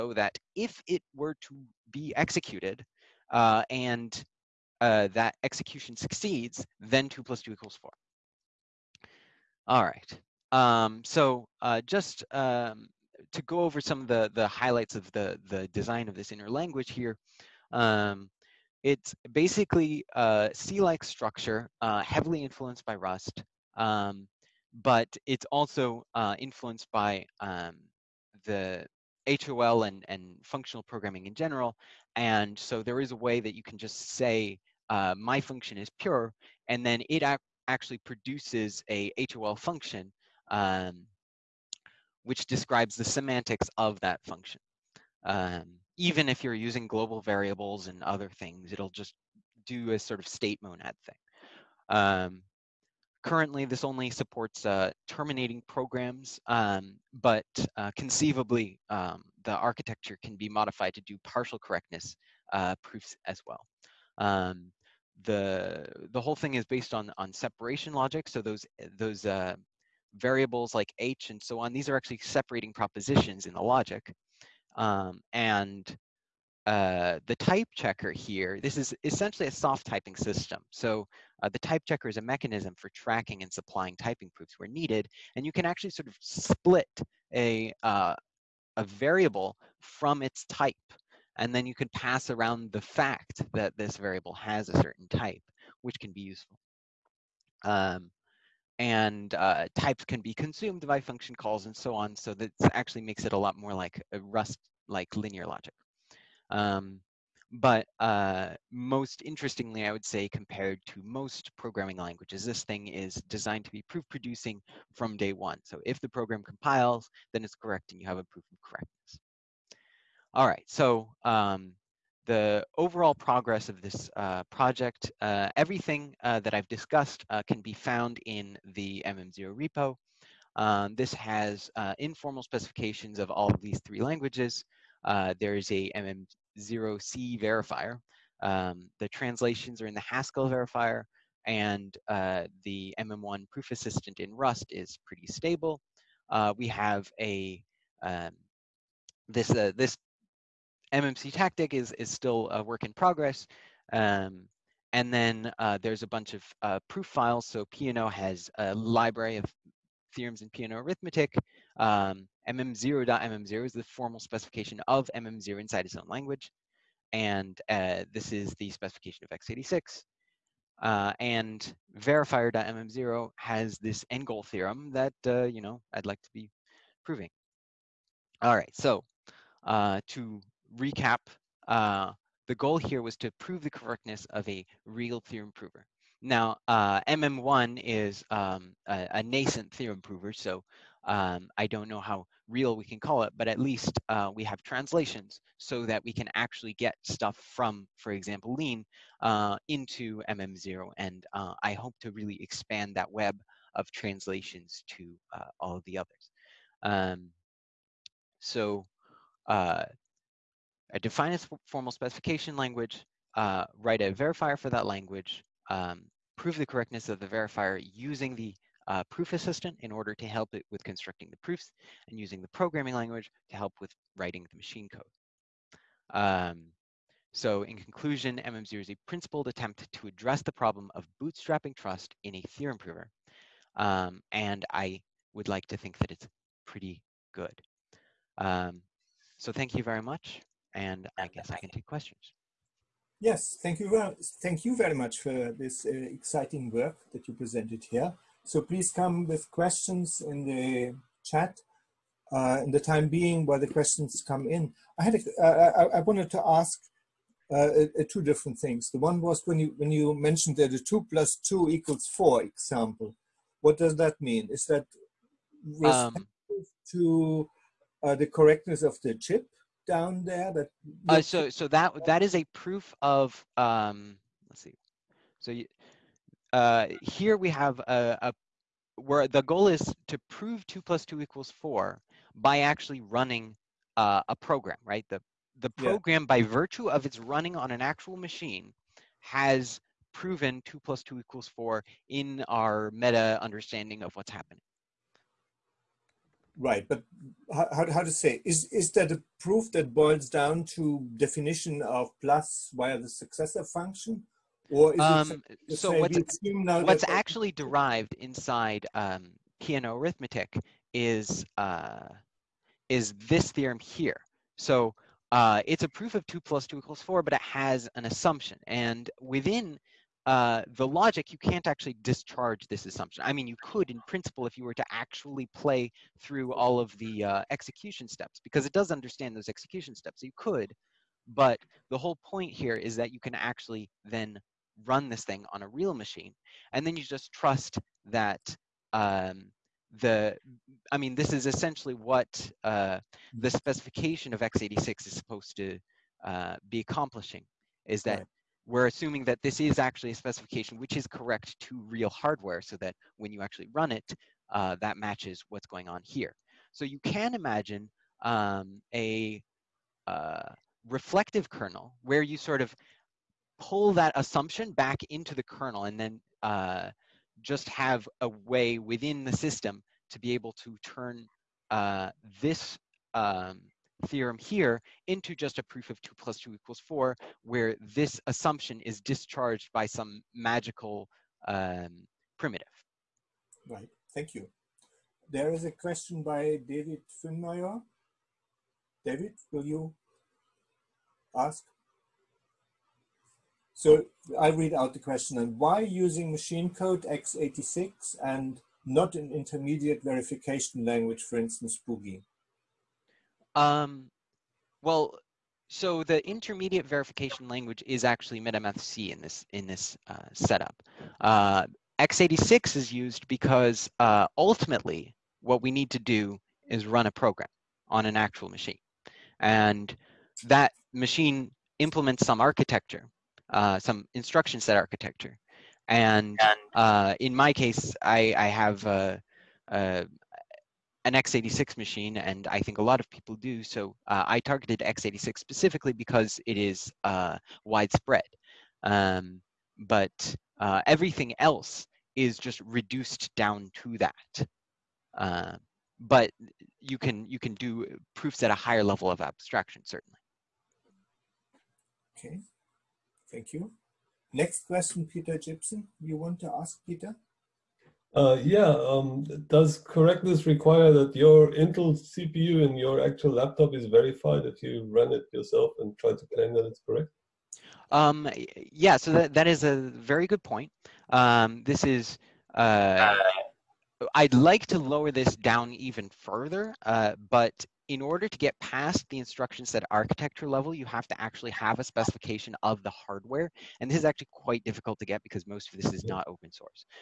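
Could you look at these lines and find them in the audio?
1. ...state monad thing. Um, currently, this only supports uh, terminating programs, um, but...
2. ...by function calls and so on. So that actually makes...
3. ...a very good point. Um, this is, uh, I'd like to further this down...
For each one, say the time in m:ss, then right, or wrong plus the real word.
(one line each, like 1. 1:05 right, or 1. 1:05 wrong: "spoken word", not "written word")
1. 0:50 right
2. 1:40 right
3. 7:49 wrong: "lower", not "further".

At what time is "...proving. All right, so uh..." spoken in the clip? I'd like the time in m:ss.
2:57.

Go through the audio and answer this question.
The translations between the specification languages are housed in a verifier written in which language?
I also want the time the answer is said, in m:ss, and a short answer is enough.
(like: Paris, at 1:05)
Haskell, at 2:20.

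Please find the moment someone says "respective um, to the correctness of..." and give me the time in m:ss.
4:25.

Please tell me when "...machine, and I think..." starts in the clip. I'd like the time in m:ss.
7:11.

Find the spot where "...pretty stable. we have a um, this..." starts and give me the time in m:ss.
2:25.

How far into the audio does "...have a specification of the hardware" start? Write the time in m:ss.
8:01.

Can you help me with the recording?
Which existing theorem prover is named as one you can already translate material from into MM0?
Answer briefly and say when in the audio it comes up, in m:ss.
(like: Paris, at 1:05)
Lean, at 3:18.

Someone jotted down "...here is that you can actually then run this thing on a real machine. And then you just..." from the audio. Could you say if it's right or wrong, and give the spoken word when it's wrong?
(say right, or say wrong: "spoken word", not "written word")
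right.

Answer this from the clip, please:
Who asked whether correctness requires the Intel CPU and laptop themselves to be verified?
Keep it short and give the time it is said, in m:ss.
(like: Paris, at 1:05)
Peter Gibson, at 7:35.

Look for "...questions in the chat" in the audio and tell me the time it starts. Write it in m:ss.
4:09.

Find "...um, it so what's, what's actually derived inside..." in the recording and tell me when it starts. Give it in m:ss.
5:04.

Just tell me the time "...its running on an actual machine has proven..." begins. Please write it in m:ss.
4:47.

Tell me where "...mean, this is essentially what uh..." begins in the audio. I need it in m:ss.
5:40.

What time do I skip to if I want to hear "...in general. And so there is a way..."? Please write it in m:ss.
0:31.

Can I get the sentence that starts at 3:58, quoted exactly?
Um, so thank you very much.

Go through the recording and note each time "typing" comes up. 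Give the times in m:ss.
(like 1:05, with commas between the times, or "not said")
1:19, 1:23.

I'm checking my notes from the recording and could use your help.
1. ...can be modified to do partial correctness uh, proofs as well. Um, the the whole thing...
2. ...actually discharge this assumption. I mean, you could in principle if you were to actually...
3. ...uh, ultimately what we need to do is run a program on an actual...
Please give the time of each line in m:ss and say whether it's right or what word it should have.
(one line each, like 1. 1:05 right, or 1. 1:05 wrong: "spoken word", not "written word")
1. 1:00 right
2. 5:21 right
3. 6:53 right.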